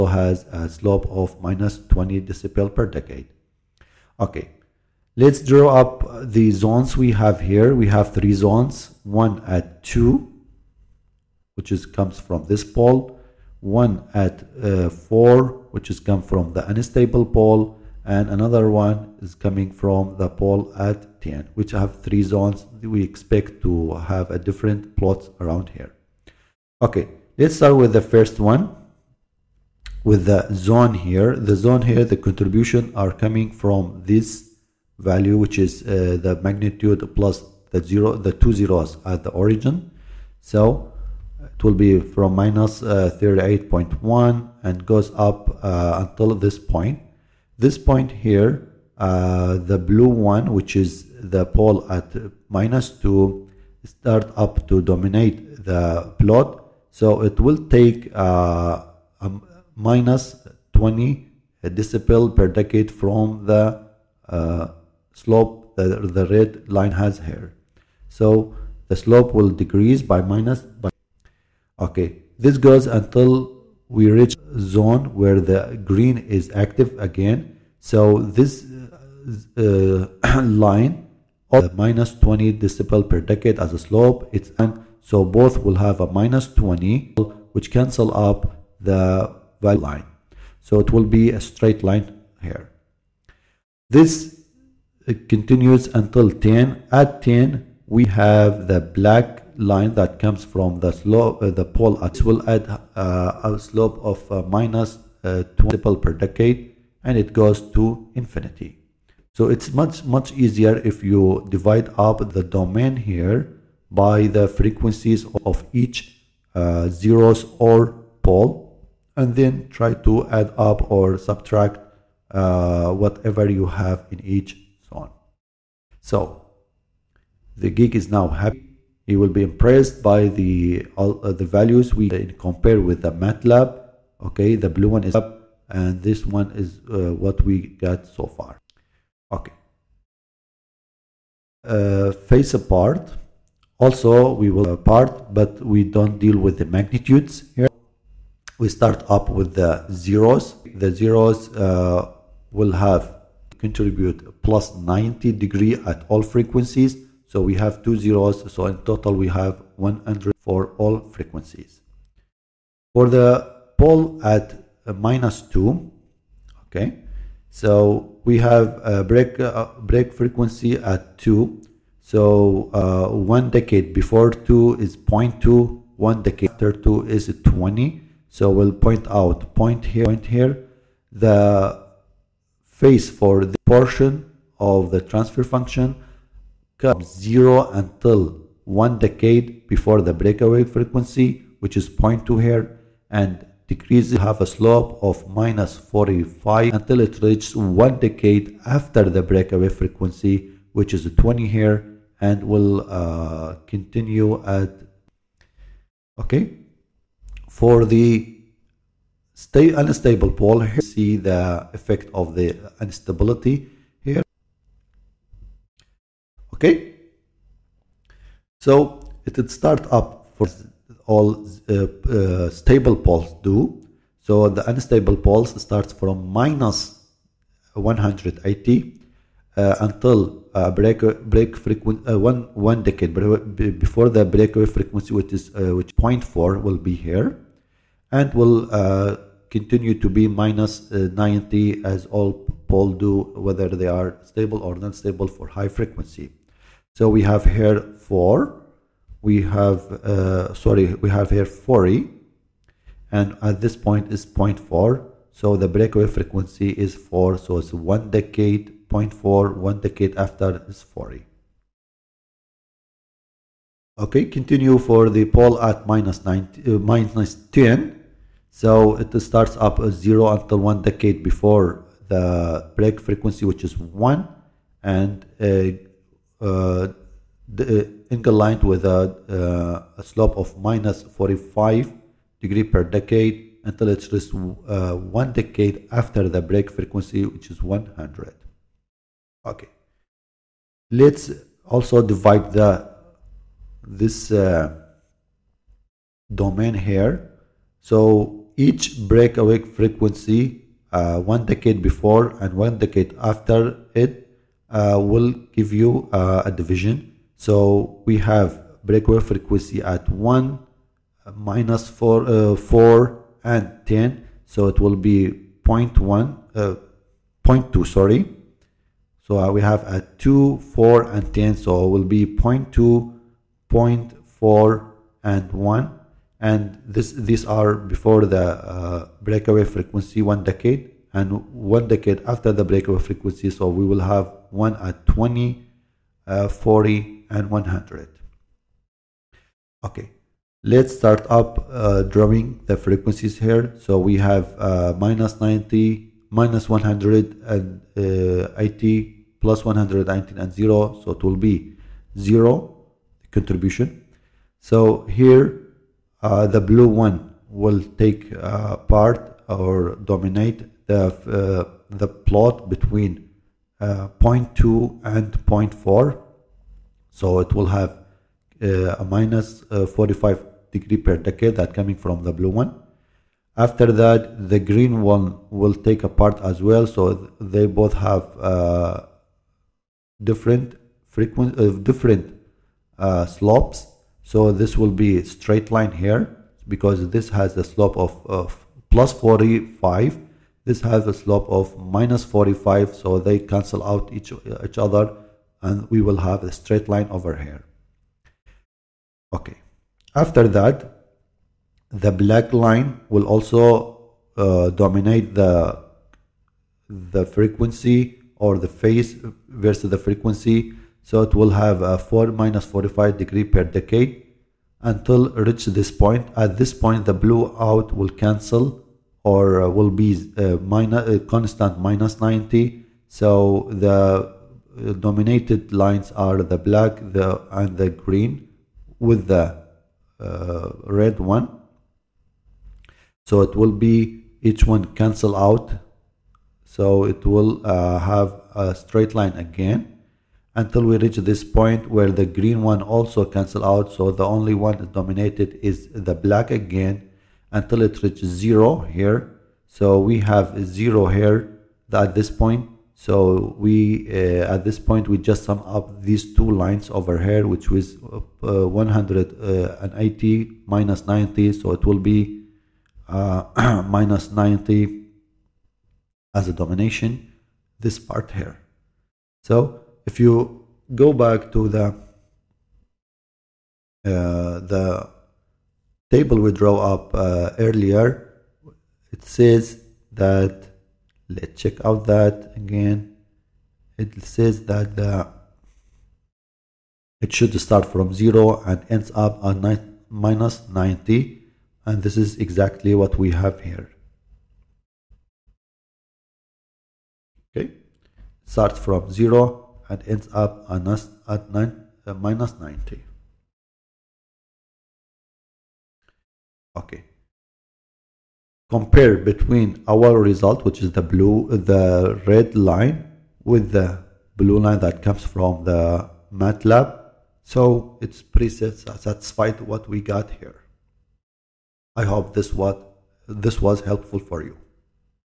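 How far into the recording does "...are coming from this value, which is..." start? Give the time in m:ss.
0:32.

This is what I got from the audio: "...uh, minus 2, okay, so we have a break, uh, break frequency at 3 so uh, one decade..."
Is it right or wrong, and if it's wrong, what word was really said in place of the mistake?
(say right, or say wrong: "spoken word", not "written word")
wrong: "2", not "3".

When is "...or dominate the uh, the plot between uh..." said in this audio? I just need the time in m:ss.
5:59.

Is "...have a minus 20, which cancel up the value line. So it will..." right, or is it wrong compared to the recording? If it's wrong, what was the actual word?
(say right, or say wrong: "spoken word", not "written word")
right.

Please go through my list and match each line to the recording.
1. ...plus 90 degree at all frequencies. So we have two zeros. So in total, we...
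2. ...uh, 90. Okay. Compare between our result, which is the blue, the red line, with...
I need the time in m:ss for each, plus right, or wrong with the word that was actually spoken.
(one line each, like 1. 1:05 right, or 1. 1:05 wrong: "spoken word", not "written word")
1. 2:34 right
2. 8:22 right.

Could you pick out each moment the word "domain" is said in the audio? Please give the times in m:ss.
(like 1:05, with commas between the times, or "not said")
1:52, 4:56.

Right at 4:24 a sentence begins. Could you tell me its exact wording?
Okay, continue for the pole at minus, 90, uh, minus 10.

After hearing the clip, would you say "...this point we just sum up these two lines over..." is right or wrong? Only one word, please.
right.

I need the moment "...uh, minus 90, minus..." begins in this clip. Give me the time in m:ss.
5:44.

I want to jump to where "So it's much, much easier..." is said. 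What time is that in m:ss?
1:49.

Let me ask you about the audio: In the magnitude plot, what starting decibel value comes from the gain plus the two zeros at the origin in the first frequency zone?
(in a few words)
38.1.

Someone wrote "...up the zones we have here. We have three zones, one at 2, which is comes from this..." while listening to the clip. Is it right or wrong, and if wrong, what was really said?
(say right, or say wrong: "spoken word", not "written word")
right.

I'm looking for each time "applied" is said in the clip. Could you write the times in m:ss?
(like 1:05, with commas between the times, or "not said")
not said.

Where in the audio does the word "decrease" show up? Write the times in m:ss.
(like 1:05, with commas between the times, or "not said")
1:09, 3:13.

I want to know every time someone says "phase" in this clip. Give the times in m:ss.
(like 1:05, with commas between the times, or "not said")
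2:22, 3:02, 6:48.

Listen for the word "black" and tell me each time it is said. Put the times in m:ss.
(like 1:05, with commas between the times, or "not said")
1:38, 6:42, 7:06, 7:26.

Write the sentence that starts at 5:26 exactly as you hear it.
And this these are before the uh, breakaway frequency one decade and one decade after the breakaway frequency.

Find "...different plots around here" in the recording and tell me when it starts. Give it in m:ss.
0:24.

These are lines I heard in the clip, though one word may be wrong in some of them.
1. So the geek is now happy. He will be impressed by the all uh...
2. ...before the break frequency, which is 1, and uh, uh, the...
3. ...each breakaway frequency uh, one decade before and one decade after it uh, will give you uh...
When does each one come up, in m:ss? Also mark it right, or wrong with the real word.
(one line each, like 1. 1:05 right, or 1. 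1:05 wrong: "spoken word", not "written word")
1. 2:05 right
2. 4:31 right
3. 4:58 right.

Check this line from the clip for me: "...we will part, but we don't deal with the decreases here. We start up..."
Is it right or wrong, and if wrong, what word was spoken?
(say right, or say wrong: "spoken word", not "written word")
wrong: "magnitudes", not "decreases".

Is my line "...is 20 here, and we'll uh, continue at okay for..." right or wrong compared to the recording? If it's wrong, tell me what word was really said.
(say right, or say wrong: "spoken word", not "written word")
right.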